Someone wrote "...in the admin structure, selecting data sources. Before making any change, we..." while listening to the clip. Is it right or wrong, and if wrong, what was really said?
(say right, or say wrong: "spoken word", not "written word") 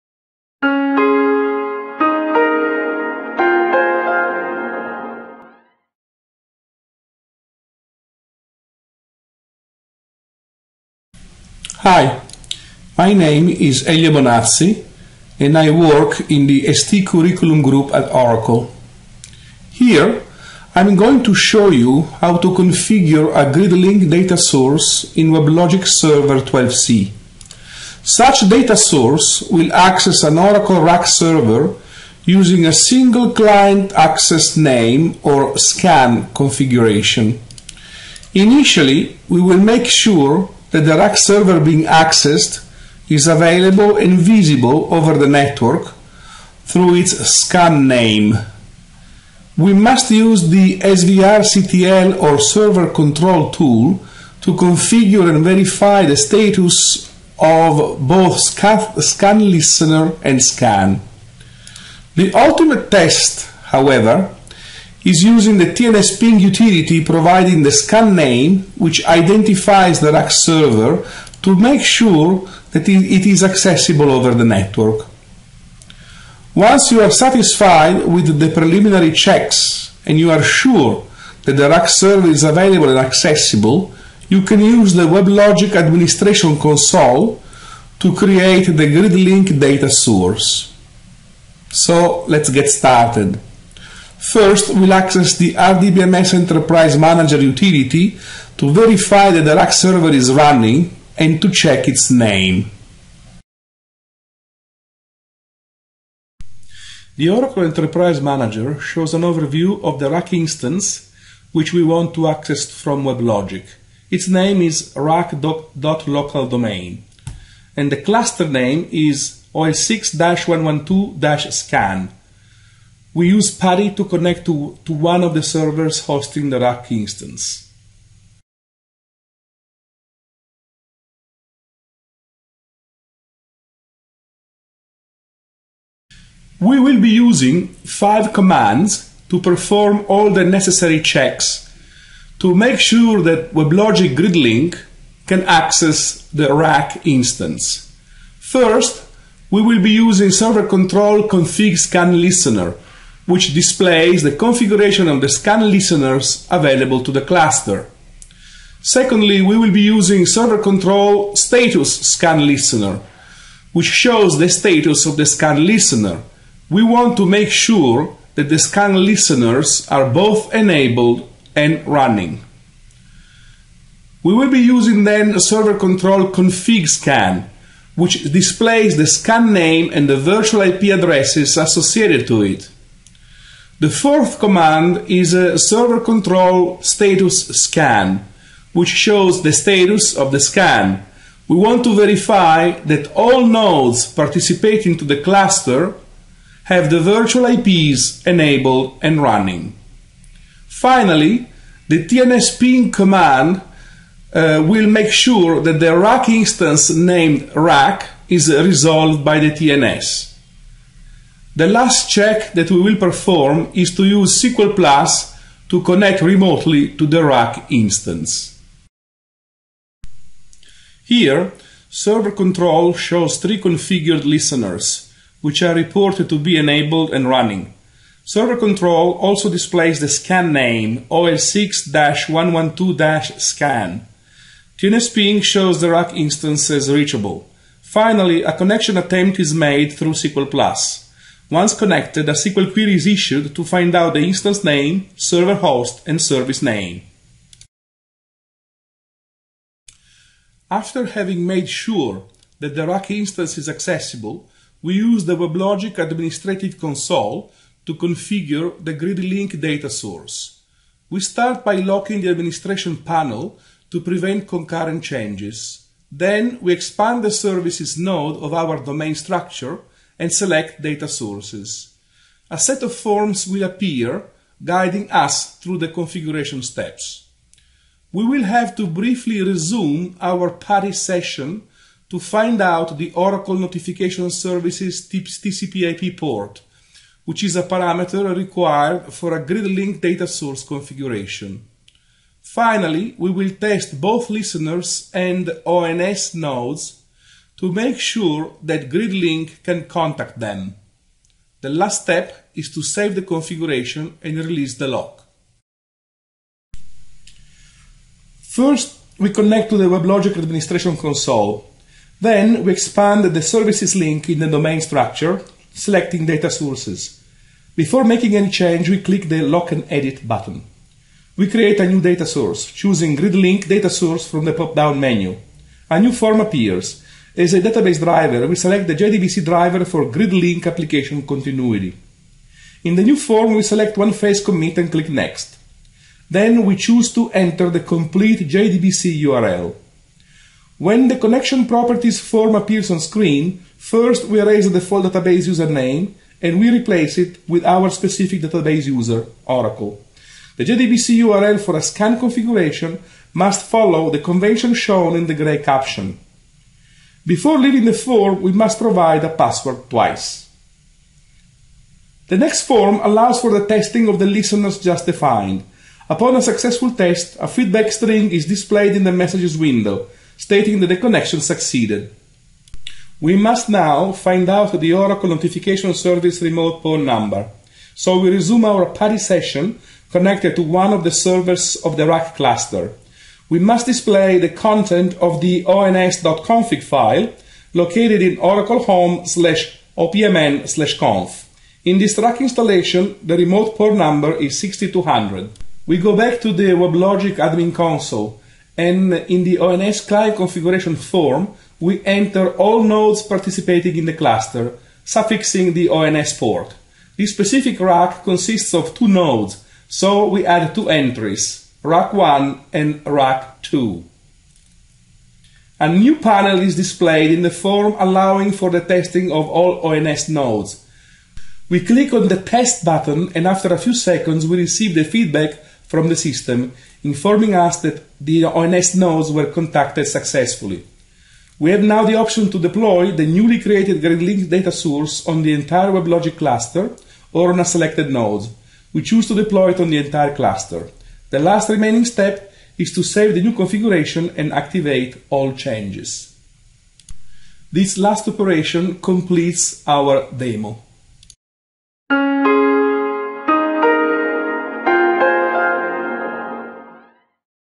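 wrong: "domain", not "admin".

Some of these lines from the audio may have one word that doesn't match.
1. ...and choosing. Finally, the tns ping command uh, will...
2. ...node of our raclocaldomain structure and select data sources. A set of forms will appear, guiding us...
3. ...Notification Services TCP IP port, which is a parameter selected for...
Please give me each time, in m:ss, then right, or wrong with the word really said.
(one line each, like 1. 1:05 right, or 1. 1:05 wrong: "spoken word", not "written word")
1. 3:19 wrong: "running", not "choosing"
2. 4:27 wrong: "domain", not "raclocaldomain"
3. 4:43 wrong: "required", not "selected".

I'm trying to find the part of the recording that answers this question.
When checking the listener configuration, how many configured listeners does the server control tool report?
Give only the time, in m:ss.
3:43.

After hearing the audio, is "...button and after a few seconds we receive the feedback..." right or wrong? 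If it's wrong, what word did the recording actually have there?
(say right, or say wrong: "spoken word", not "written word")
right.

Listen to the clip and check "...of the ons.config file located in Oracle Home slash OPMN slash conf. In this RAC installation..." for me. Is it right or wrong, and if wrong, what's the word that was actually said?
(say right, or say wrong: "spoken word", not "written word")
right.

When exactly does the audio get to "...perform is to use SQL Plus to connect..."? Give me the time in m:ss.
3:32.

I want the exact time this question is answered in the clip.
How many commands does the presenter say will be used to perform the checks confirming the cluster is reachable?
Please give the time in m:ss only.
2:17.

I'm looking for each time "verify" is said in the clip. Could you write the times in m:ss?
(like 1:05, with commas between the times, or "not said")
0:55, 1:38, 3:11.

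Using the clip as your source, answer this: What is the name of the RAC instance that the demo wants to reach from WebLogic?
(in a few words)
rac.localdomain.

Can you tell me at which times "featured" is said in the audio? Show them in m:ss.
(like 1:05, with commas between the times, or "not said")
not said.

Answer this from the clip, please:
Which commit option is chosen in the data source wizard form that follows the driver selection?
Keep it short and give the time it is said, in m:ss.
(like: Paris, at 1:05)
one phase commit, at 5:33.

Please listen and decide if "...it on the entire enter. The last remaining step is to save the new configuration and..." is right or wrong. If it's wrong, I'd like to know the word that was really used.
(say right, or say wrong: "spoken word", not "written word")
wrong: "cluster", not "enter".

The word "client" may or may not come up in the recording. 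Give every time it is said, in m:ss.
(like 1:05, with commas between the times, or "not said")
0:33, 6:39.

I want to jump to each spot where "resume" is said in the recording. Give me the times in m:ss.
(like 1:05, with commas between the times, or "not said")
4:39, 6:18.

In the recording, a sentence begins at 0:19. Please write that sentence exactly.
Here, I'm going to show you how to configure a GridLink data source in WebLogic Server 12c.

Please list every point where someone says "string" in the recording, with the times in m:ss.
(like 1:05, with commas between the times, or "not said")
6:07.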